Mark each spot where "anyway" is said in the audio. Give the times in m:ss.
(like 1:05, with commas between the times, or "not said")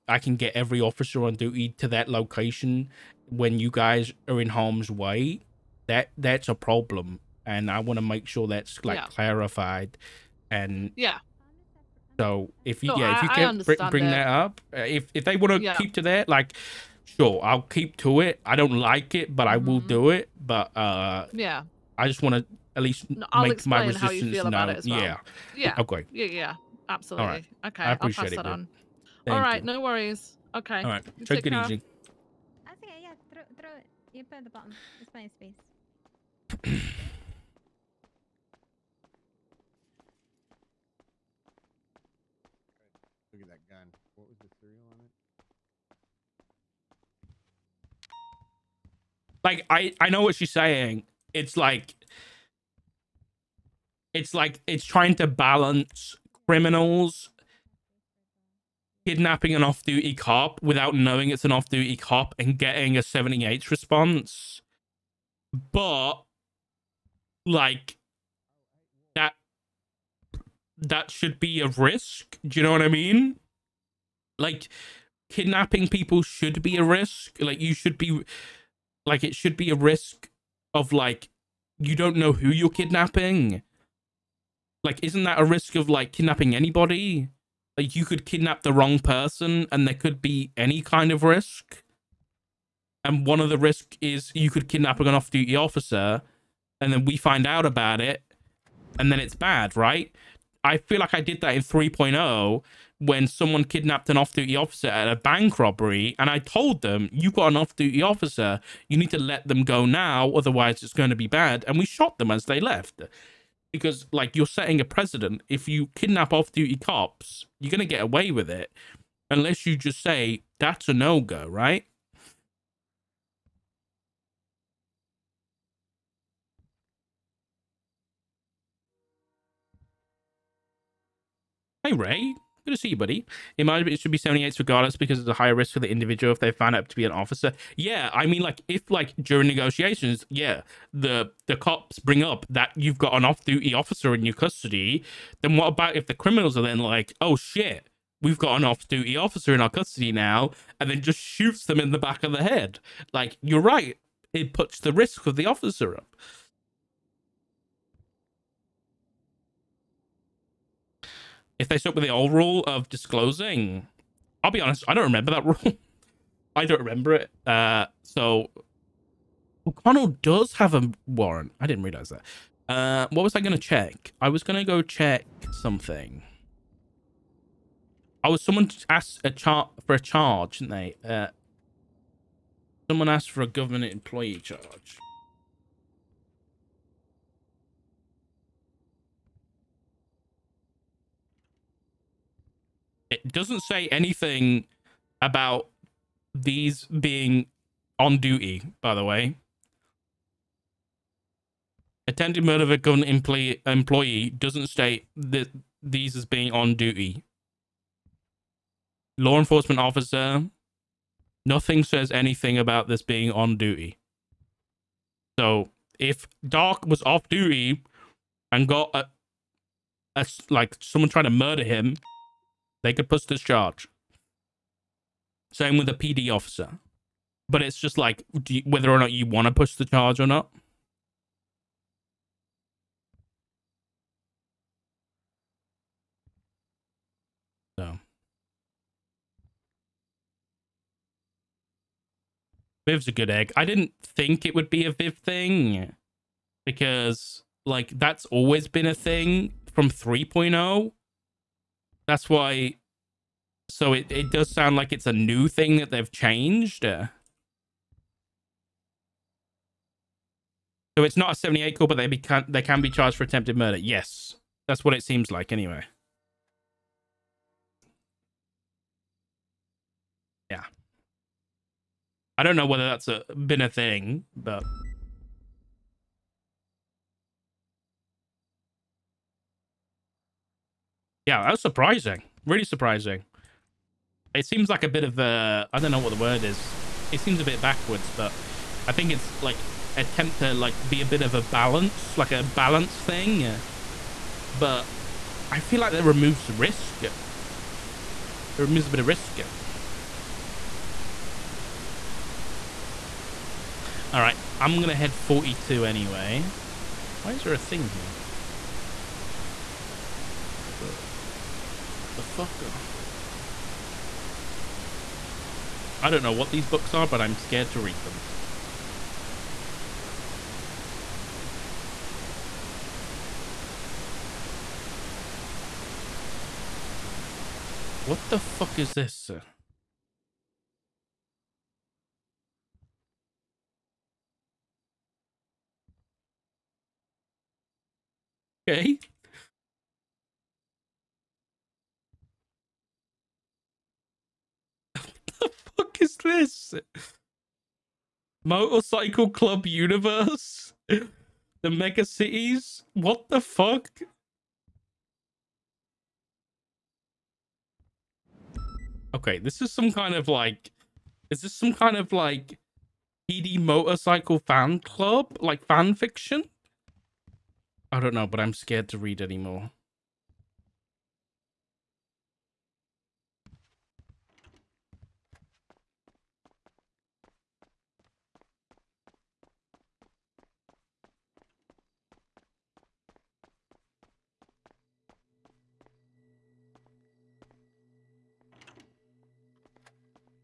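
4:25, 5:05.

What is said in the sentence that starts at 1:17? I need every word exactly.
Like you should be like it should be a risk of like you don't know who you're kidnapping.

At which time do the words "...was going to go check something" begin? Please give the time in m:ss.
2:54.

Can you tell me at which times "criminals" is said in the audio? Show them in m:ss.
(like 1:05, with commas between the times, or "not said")
0:56, 2:26.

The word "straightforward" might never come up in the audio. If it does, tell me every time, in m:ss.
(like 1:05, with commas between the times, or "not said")
not said.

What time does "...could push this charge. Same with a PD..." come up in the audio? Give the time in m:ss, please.
3:42.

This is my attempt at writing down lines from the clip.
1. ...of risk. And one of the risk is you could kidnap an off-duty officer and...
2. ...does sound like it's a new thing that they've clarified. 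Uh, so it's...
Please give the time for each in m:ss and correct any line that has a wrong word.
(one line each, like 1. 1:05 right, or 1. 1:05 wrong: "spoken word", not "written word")
1. 1:31 right
2. 4:14 wrong: "changed", not "clarified".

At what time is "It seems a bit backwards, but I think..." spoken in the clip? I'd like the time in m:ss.
4:47.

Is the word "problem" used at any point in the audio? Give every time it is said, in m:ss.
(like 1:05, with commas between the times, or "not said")
0:06.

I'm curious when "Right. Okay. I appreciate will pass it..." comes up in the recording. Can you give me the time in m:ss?
0:27.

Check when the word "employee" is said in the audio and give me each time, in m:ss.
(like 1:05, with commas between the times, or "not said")
3:03, 3:23.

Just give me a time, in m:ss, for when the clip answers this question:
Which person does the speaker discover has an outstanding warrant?
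2:49.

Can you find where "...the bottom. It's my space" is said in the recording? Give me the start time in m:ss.
0:34.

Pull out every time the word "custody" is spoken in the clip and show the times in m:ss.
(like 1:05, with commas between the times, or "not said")
2:24, 2:29.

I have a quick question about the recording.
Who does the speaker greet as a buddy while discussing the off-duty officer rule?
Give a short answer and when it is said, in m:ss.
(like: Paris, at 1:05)
Ray, at 2:11.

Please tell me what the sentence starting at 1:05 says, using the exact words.
But like that that should be a risk.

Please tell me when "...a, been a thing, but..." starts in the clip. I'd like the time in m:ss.
4:33.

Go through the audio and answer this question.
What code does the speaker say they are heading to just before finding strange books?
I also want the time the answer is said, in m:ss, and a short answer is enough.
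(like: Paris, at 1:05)
42, at 5:05.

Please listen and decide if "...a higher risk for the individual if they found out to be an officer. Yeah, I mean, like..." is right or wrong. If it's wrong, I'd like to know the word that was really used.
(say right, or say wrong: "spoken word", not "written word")
right.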